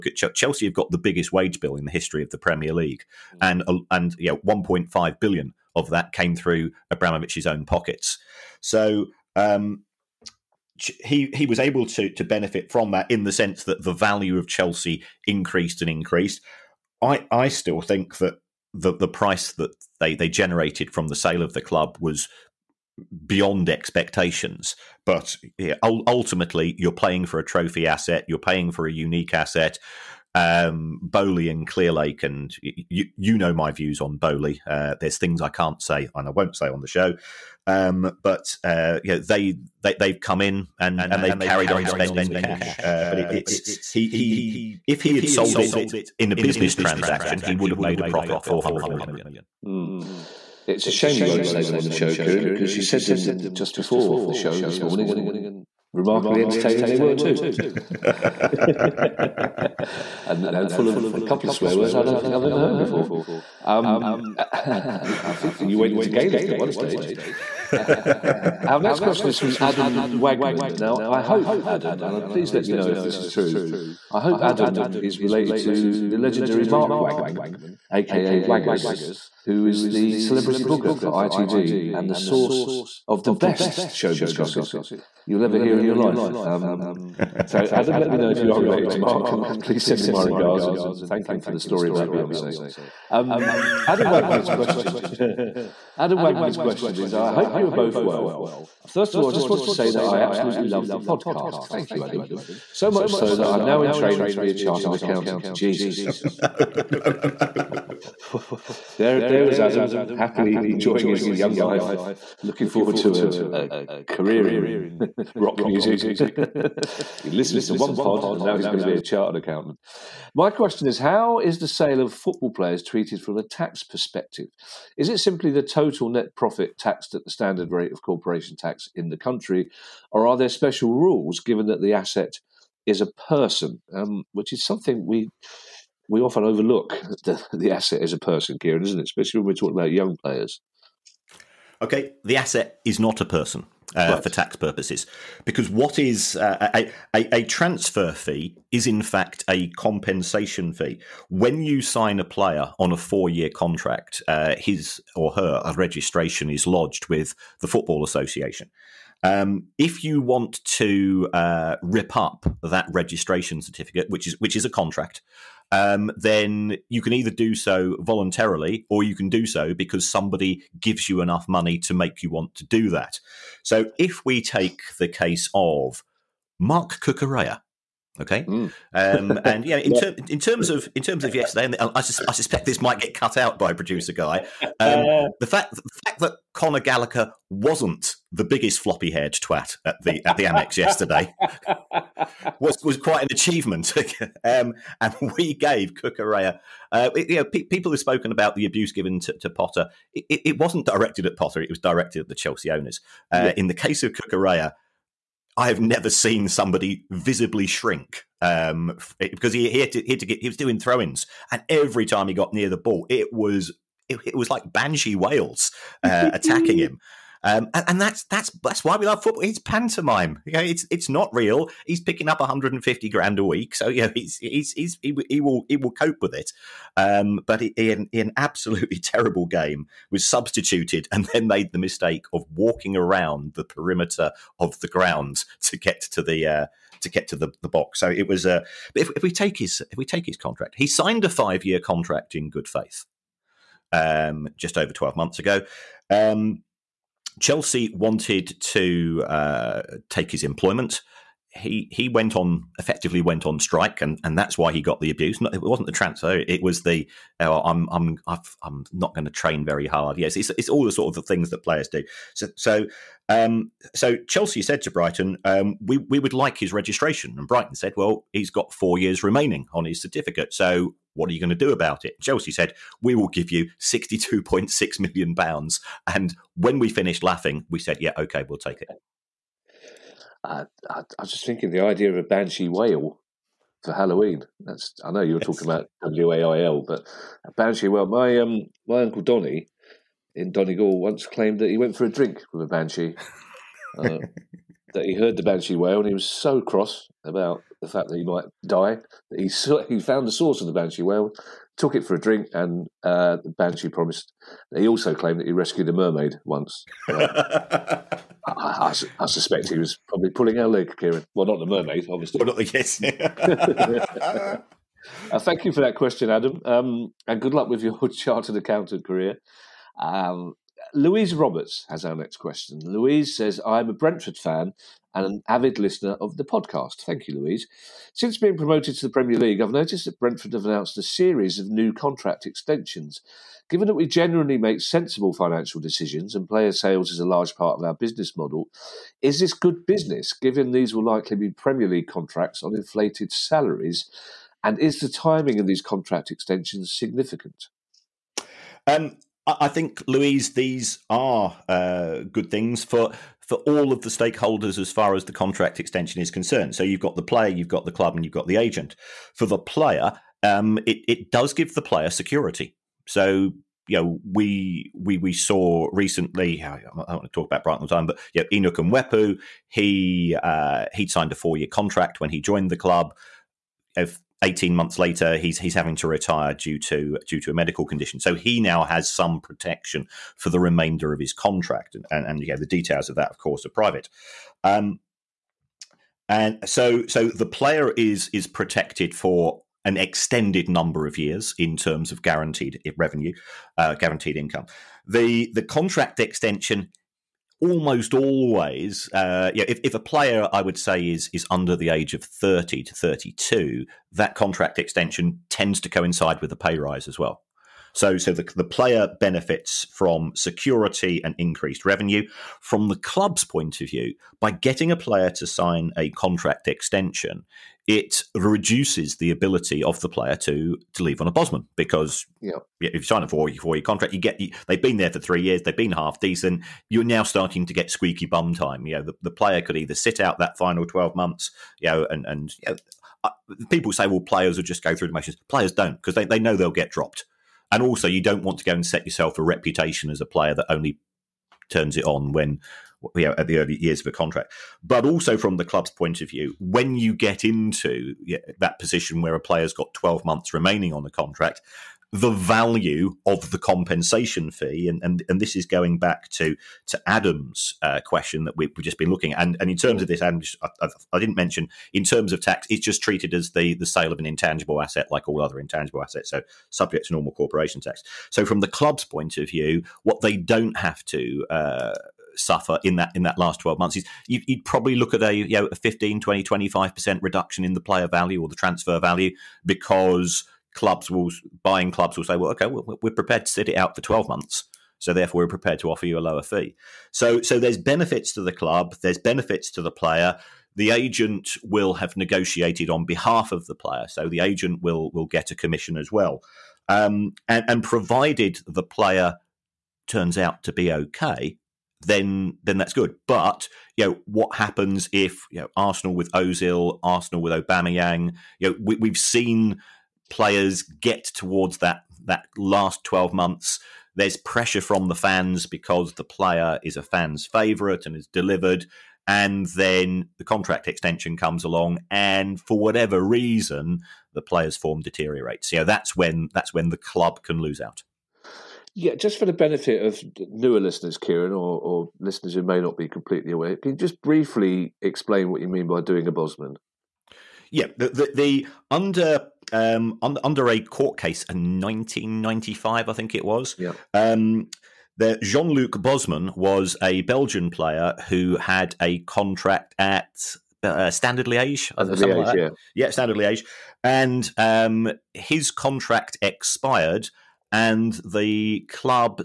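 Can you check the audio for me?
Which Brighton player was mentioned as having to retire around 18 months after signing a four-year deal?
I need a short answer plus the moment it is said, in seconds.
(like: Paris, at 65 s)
Enock Mwepu, at 368 s.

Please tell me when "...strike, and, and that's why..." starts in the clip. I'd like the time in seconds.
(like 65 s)
253 s.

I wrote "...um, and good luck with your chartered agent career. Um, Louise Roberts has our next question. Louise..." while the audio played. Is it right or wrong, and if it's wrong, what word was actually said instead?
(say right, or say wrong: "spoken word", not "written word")
wrong: "accountant", not "agent".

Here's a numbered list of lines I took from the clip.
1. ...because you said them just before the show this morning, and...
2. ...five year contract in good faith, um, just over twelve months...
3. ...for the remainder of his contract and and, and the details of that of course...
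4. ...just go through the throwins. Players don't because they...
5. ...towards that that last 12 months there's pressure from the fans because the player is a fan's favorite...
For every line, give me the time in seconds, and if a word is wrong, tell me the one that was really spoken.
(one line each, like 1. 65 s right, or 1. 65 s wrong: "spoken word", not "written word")
1. 52 s right
2. 241 s right
3. 380 s right
4. 434 s wrong: "motions", not "throwins"
5. 511 s right.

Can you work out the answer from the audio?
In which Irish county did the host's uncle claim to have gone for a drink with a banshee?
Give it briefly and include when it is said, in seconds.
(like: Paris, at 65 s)
Donegal, at 290 s.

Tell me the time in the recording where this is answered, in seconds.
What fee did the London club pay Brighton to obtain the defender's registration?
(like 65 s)
273 s.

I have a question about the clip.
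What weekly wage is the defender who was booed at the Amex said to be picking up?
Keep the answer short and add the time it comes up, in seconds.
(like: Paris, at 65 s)
150 grand, at 222 s.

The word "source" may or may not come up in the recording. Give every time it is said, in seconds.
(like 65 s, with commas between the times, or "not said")
82 s, 300 s.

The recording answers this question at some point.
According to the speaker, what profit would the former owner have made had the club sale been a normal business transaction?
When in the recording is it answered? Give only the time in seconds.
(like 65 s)
48 s.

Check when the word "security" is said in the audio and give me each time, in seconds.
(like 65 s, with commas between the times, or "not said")
362 s, 410 s.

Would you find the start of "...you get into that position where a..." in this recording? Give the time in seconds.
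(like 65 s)
446 s.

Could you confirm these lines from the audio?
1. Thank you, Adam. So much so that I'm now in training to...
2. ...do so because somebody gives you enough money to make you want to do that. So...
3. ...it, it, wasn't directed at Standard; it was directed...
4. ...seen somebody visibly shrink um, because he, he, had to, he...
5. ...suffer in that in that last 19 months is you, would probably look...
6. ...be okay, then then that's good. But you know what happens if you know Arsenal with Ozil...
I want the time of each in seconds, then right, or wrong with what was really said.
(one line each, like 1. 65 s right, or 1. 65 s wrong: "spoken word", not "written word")
1. 101 s right
2. 169 s right
3. 200 s wrong: "Potter", not "Standard"
4. 206 s right
5. 472 s wrong: "12", not "19"
6. 500 s right.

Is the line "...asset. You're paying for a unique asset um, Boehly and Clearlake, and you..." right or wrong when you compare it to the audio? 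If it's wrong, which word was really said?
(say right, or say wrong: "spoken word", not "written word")
right.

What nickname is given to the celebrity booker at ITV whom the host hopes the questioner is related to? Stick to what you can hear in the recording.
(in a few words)
Waggers.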